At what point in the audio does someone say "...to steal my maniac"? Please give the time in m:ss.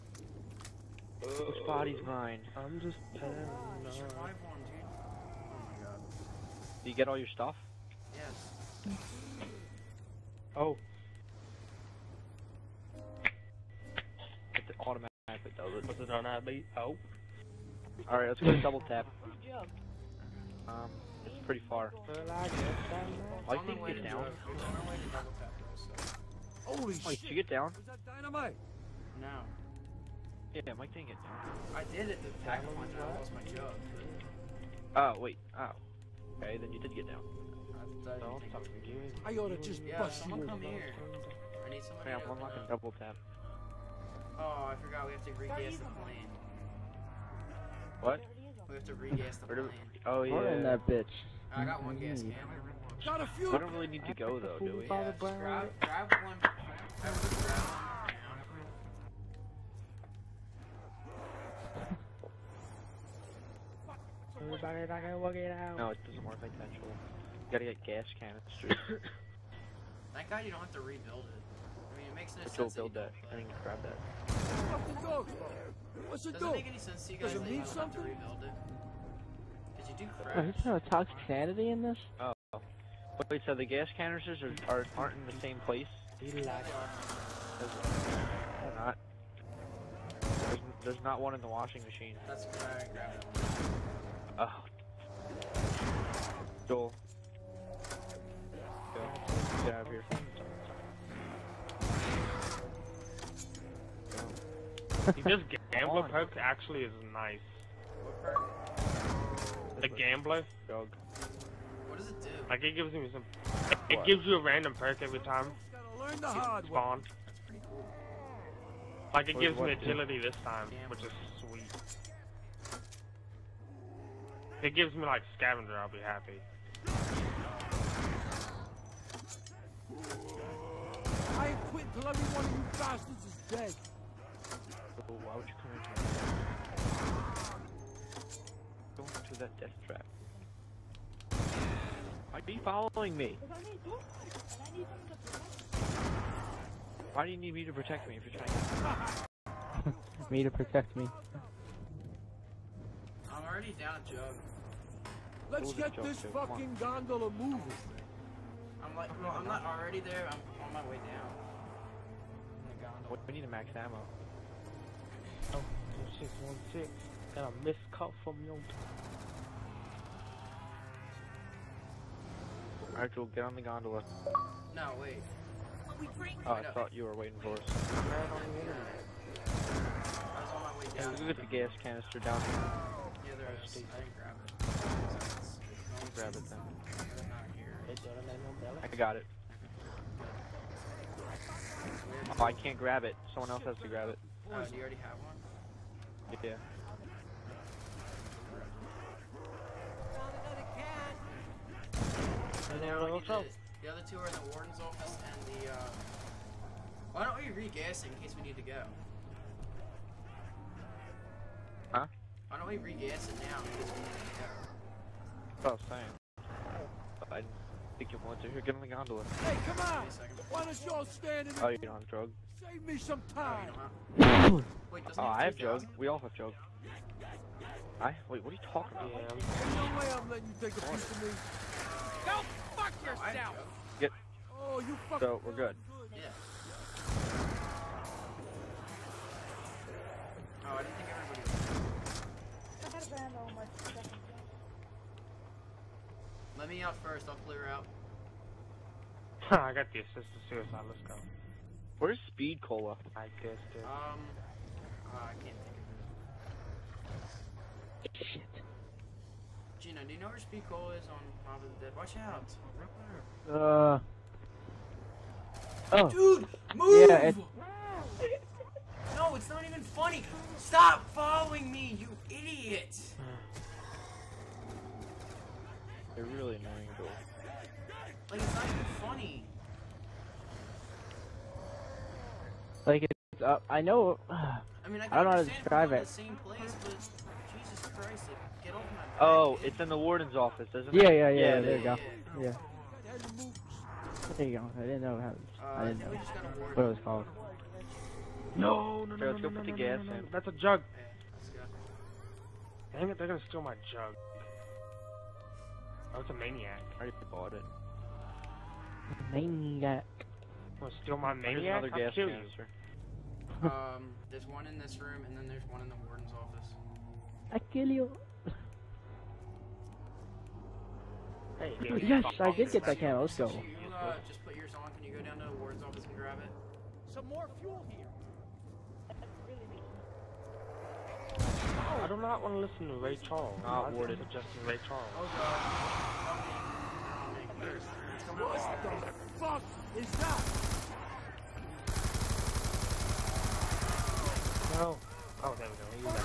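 5:10.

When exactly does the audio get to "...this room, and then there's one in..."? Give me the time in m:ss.
5:14.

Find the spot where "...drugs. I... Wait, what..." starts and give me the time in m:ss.
3:46.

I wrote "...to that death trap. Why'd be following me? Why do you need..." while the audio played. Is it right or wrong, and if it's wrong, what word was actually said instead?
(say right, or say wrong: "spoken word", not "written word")
right.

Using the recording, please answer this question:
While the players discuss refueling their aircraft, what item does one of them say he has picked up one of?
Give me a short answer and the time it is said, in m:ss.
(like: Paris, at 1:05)
Gas can, at 0:51.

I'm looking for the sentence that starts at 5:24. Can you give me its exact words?
Can you go down to I do not want to listen to Ray Charles.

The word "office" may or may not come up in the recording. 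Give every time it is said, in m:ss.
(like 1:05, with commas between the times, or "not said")
3:24, 4:50, 5:16.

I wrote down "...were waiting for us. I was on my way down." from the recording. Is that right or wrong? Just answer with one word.
right.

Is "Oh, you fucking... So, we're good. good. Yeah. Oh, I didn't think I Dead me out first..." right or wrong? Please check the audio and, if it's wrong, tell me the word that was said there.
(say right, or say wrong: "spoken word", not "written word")
wrong: "Let", not "Dead".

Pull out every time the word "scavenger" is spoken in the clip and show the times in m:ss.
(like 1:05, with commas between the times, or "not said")
2:05.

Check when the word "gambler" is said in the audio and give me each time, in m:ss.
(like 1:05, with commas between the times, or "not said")
1:45, 1:49.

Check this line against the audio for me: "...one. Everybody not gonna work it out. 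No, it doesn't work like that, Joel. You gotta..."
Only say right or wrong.
right.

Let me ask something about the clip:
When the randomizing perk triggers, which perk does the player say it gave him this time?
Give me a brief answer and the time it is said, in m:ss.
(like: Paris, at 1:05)
Agility, at 1:59.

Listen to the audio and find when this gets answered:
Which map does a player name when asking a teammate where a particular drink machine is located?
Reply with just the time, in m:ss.
4:21.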